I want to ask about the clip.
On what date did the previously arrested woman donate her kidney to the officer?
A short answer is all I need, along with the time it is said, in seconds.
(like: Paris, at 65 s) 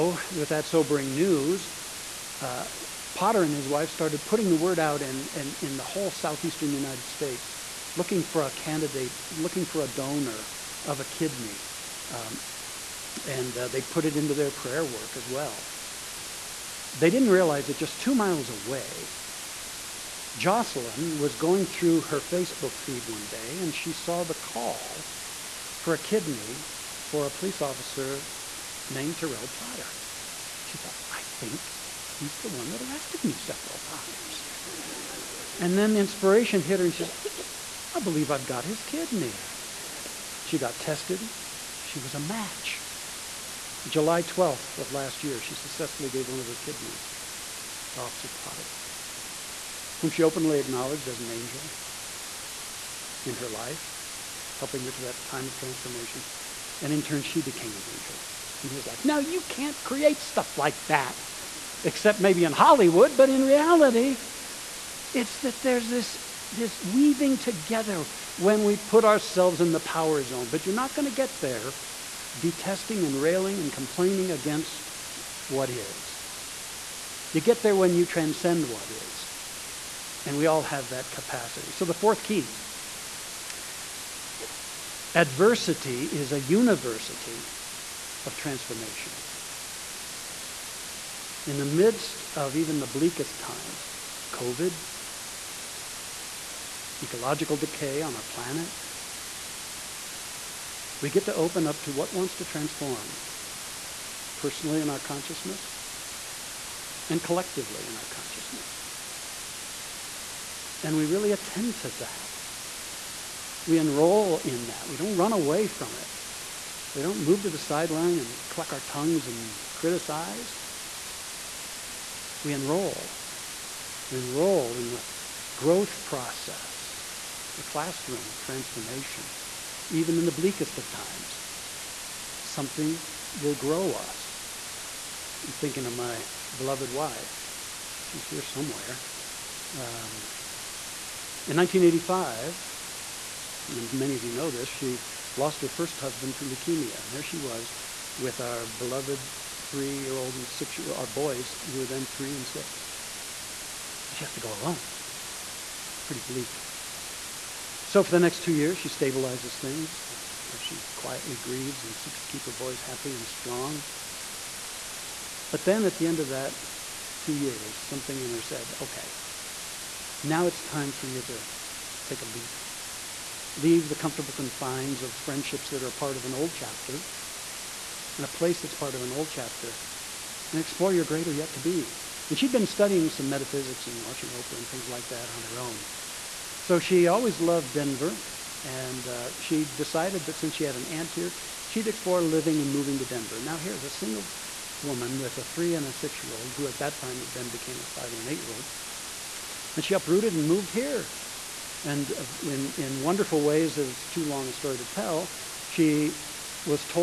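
July 12, at 43 s.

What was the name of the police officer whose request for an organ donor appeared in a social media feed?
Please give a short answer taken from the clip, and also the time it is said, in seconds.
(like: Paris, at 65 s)
Terrell Potter, at 29 s.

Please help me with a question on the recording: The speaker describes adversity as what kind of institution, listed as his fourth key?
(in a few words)
university of transformation.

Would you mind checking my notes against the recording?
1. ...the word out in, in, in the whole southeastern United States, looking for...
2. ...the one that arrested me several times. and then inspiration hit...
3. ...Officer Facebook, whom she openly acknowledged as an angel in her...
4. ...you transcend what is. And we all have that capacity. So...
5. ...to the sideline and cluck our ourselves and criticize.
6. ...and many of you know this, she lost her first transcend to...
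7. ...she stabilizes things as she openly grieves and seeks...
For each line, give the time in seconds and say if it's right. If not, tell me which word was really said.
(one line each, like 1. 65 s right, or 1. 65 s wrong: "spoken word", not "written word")
1. 4 s right
2. 32 s right
3. 47 s wrong: "Potter", not "Facebook"
4. 77 s right
5. 117 s wrong: "tongues", not "ourselves"
6. 143 s wrong: "husband", not "transcend"
7. 158 s wrong: "quietly", not "openly".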